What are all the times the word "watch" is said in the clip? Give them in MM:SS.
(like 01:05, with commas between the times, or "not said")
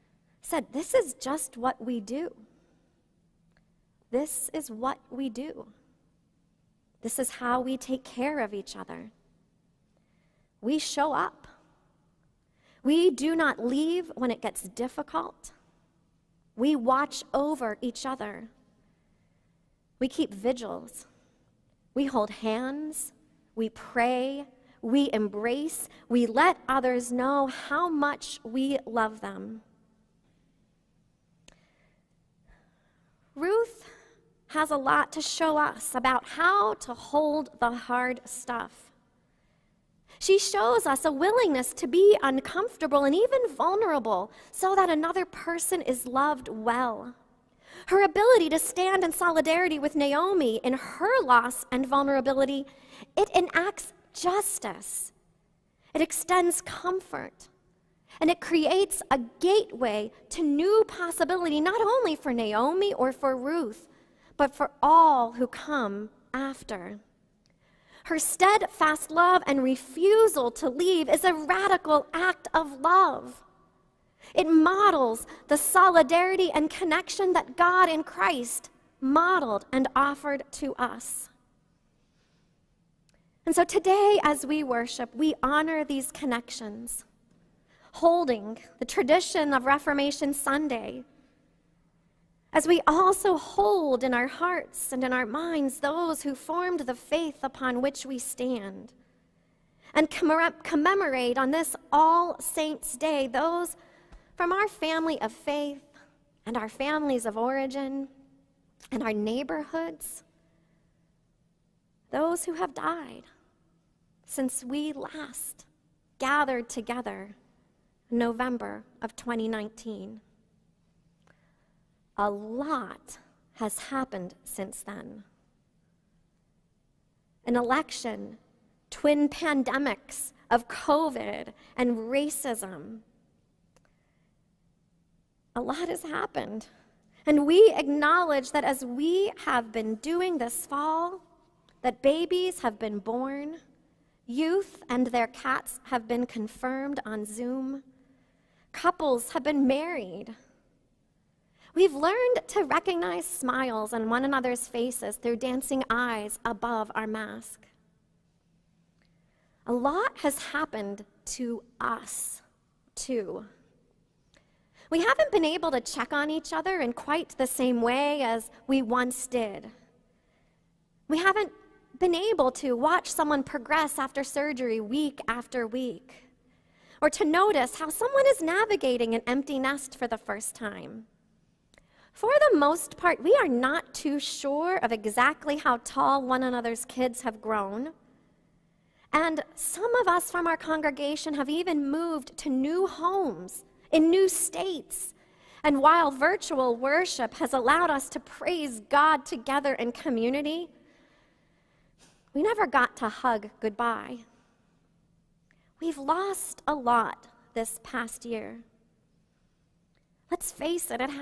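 00:16, 02:52.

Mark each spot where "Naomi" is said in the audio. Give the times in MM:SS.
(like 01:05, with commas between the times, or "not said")
00:49, 01:02.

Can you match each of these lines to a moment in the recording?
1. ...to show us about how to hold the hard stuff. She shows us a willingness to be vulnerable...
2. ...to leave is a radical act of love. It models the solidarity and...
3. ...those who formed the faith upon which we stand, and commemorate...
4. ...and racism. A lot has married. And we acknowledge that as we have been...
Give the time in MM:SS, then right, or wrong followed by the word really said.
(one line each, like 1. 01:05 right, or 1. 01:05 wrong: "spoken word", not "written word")
1. 00:35 wrong: "uncomfortable", not "vulnerable"
2. 01:10 right
3. 01:35 right
4. 02:11 wrong: "happened", not "married".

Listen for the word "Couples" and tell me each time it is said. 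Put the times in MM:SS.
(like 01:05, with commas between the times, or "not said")
02:28.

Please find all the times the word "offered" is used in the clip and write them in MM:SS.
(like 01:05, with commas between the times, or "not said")
01:19.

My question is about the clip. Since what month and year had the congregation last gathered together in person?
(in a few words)
November 2019.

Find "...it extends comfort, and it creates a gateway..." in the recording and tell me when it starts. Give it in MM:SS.
00:55.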